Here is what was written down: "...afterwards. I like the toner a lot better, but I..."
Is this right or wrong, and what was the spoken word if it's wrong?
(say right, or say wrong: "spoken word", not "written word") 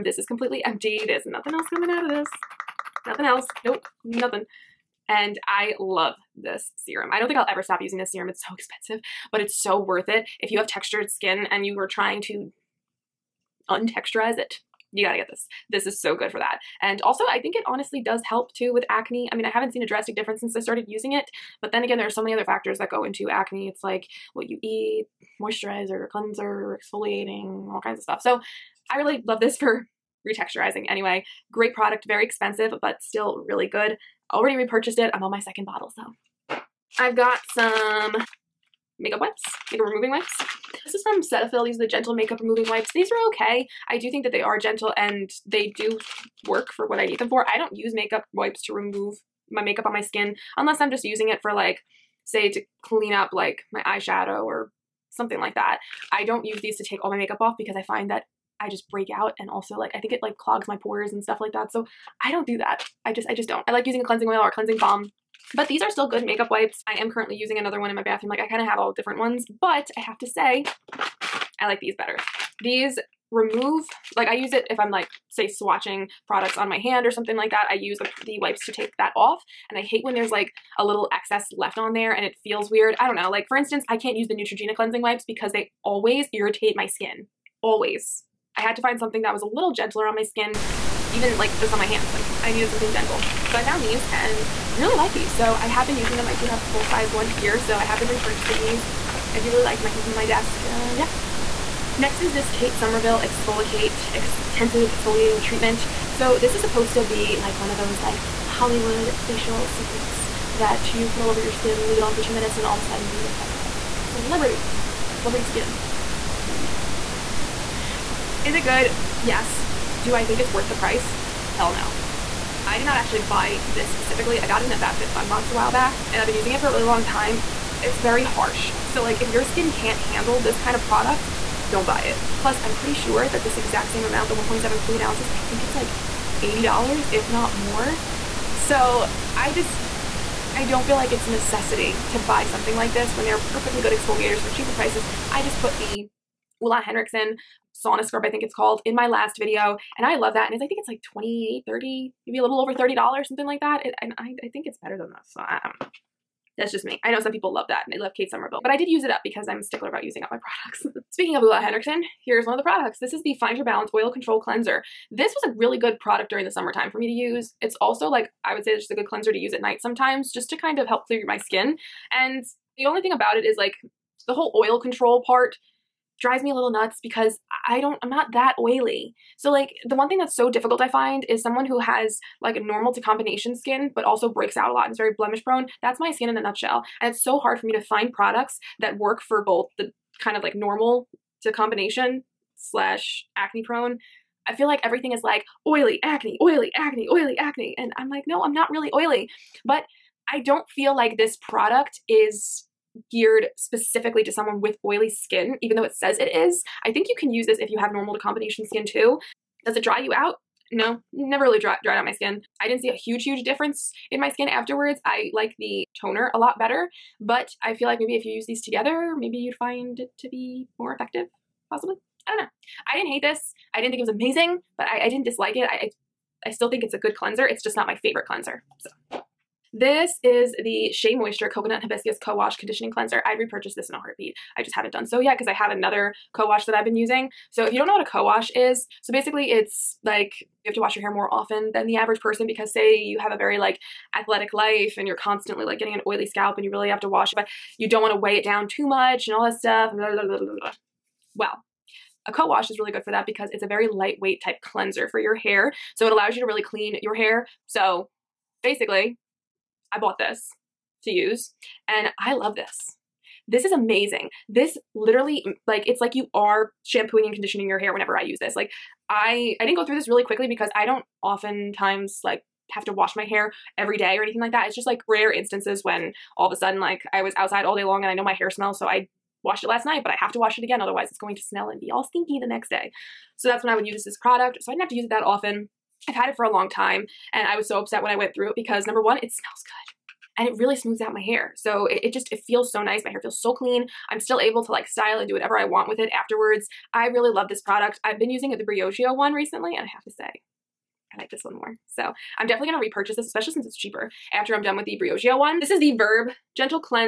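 right.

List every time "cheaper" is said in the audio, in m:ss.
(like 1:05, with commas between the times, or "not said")
2:24, 5:03.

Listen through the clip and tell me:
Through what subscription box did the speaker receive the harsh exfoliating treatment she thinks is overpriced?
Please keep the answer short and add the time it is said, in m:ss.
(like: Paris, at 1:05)
FabFitFun, at 2:04.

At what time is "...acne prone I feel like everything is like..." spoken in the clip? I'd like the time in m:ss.
3:13.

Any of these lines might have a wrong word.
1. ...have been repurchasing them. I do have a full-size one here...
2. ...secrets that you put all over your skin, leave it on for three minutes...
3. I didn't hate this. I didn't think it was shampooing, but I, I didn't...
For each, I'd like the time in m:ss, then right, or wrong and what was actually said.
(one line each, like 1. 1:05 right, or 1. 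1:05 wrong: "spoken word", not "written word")
1. 1:35 wrong: "using", not "repurchasing"
2. 1:49 wrong: "two", not "three"
3. 3:42 wrong: "amazing", not "shampooing".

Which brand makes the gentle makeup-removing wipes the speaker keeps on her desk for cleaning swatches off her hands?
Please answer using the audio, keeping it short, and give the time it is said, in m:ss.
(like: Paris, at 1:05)
Cetaphil, at 0:41.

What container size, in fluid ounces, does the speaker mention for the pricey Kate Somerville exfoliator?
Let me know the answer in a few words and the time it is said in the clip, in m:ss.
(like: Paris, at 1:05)
1.7, at 2:14.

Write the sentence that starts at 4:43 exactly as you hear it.
So that's when I would use this product.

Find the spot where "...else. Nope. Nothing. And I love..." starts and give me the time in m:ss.
0:03.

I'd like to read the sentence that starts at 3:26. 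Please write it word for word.
I think you can use this if you have normal to combination skin too.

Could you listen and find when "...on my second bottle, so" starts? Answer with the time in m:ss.
0:35.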